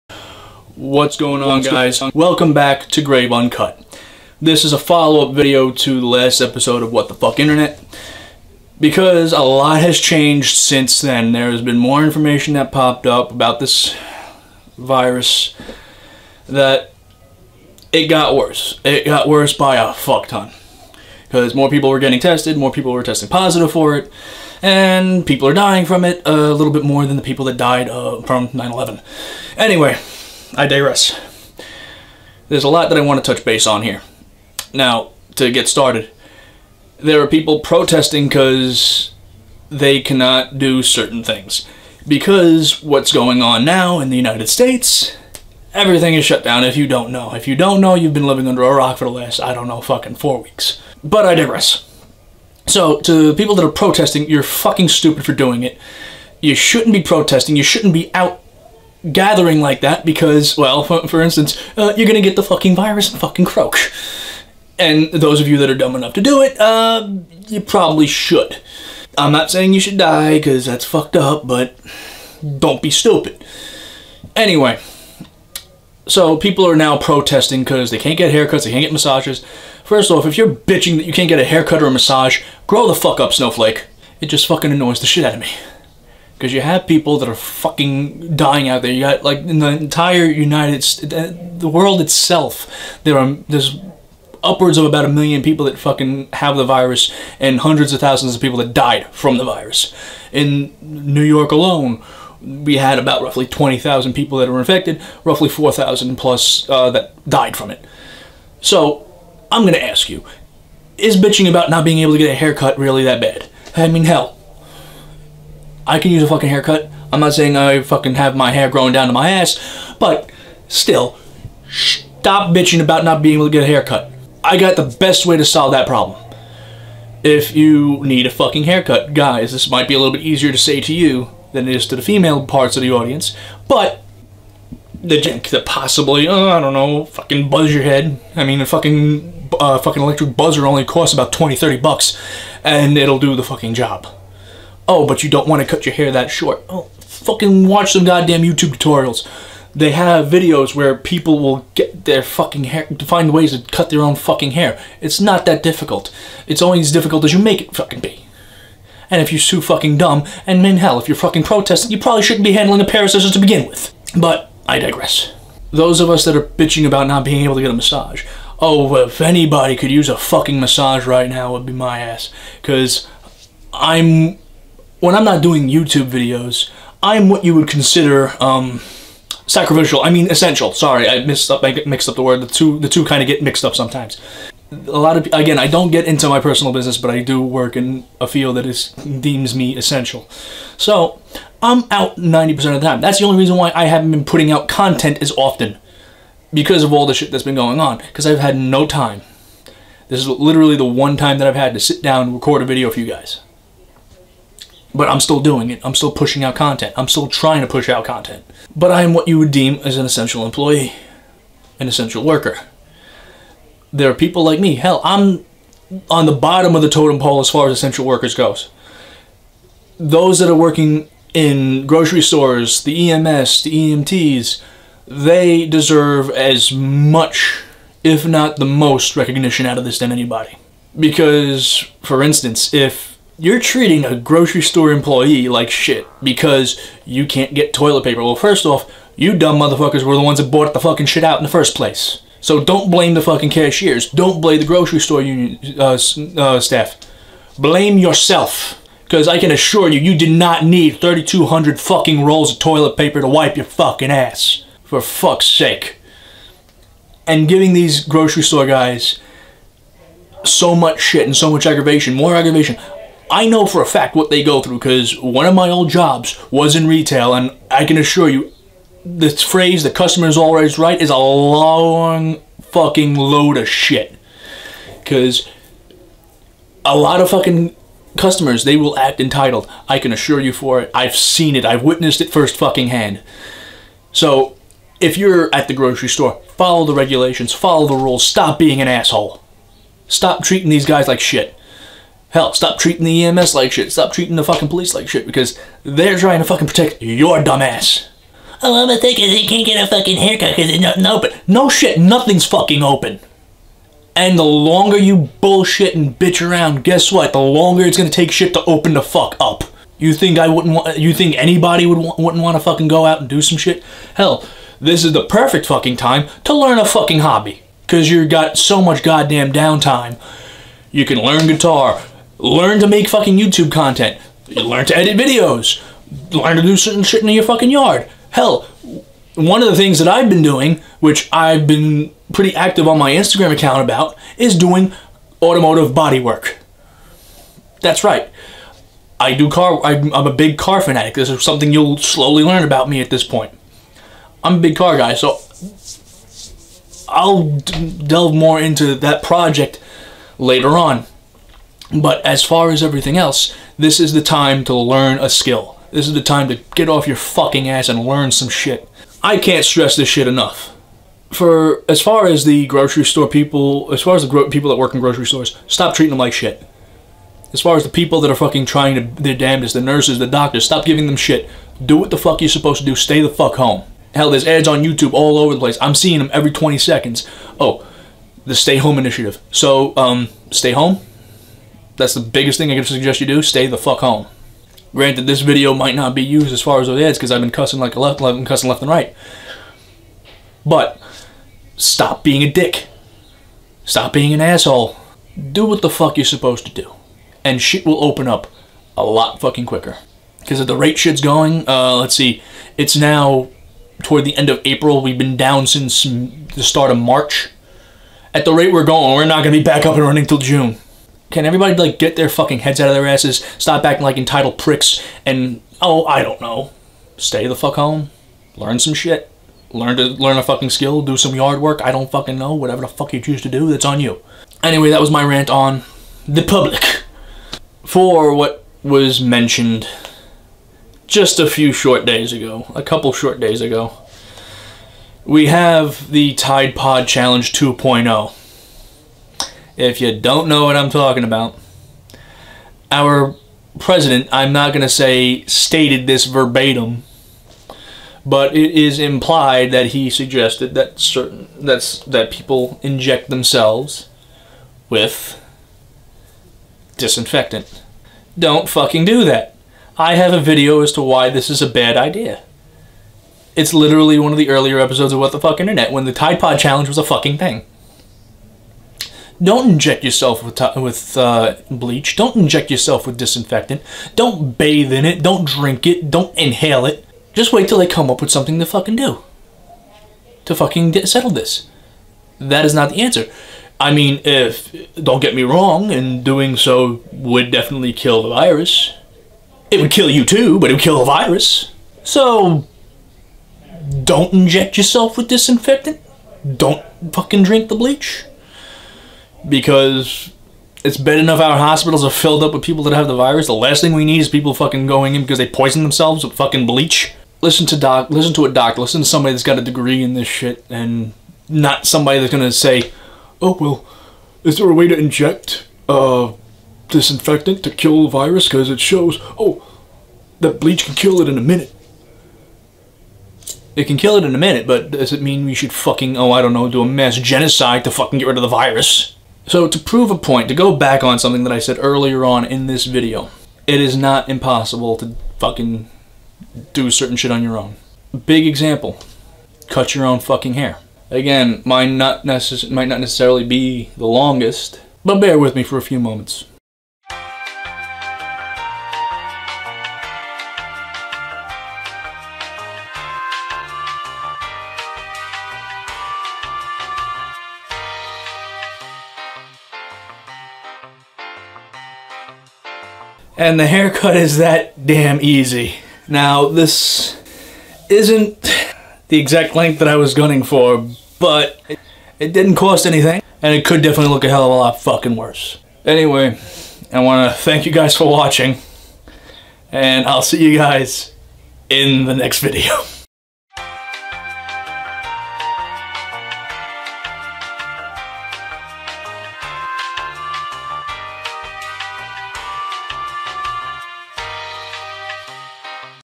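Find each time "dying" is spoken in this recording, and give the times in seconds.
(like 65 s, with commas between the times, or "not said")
25 s, 88 s.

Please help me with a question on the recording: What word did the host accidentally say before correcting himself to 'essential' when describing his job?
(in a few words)
sacrificial.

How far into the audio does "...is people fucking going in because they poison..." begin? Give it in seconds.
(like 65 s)
504 s.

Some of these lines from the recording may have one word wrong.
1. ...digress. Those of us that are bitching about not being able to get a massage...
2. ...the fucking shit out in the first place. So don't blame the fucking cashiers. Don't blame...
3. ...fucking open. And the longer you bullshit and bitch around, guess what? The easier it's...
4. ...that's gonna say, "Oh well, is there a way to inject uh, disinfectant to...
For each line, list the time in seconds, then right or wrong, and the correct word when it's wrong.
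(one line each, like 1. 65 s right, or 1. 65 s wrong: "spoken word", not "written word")
1. 164 s right
2. 240 s right
3. 302 s wrong: "longer", not "easier"
4. 512 s right.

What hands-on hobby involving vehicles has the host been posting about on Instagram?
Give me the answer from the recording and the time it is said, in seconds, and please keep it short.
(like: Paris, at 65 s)
automotive body work, at 335 s.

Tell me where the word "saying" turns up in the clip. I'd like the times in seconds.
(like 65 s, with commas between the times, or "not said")
69 s, 117 s.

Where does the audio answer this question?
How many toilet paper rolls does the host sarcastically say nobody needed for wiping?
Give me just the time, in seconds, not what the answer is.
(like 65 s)
251 s.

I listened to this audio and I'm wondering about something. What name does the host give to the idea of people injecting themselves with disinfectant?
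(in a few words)
Tide Pod Challenge 2.0.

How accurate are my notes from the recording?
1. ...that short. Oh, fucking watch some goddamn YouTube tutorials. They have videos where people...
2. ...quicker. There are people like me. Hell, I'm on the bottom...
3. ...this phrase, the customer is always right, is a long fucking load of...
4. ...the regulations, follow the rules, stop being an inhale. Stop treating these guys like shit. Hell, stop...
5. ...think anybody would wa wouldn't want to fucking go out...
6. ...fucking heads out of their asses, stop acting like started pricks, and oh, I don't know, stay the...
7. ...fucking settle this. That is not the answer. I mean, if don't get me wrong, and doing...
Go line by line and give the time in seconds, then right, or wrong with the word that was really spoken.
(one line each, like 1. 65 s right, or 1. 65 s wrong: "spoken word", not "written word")
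1. 146 s right
2. 212 s wrong: "worker", not "quicker"
3. 269 s right
4. 286 s wrong: "asshole", not "inhale"
5. 311 s right
6. 412 s wrong: "entitled", not "started"
7. 480 s right.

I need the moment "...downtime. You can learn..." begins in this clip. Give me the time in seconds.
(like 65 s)
319 s.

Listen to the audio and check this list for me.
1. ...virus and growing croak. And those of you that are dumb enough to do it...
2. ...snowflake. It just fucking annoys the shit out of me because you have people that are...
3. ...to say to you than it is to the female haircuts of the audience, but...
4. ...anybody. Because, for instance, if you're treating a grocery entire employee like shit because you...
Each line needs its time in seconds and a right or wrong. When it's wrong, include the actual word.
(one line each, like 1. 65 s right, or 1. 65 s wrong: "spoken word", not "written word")
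1. 62 s wrong: "fucking", not "growing"
2. 83 s right
3. 130 s wrong: "parts", not "haircuts"
4. 230 s wrong: "store", not "entire".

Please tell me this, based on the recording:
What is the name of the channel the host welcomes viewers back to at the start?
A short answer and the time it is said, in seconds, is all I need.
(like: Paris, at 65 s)
Grave Uncut, at 3 s.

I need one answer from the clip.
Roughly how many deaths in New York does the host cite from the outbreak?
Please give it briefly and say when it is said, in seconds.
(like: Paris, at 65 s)
4,000, at 105 s.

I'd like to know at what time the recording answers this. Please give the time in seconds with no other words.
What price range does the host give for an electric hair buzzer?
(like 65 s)
141 s.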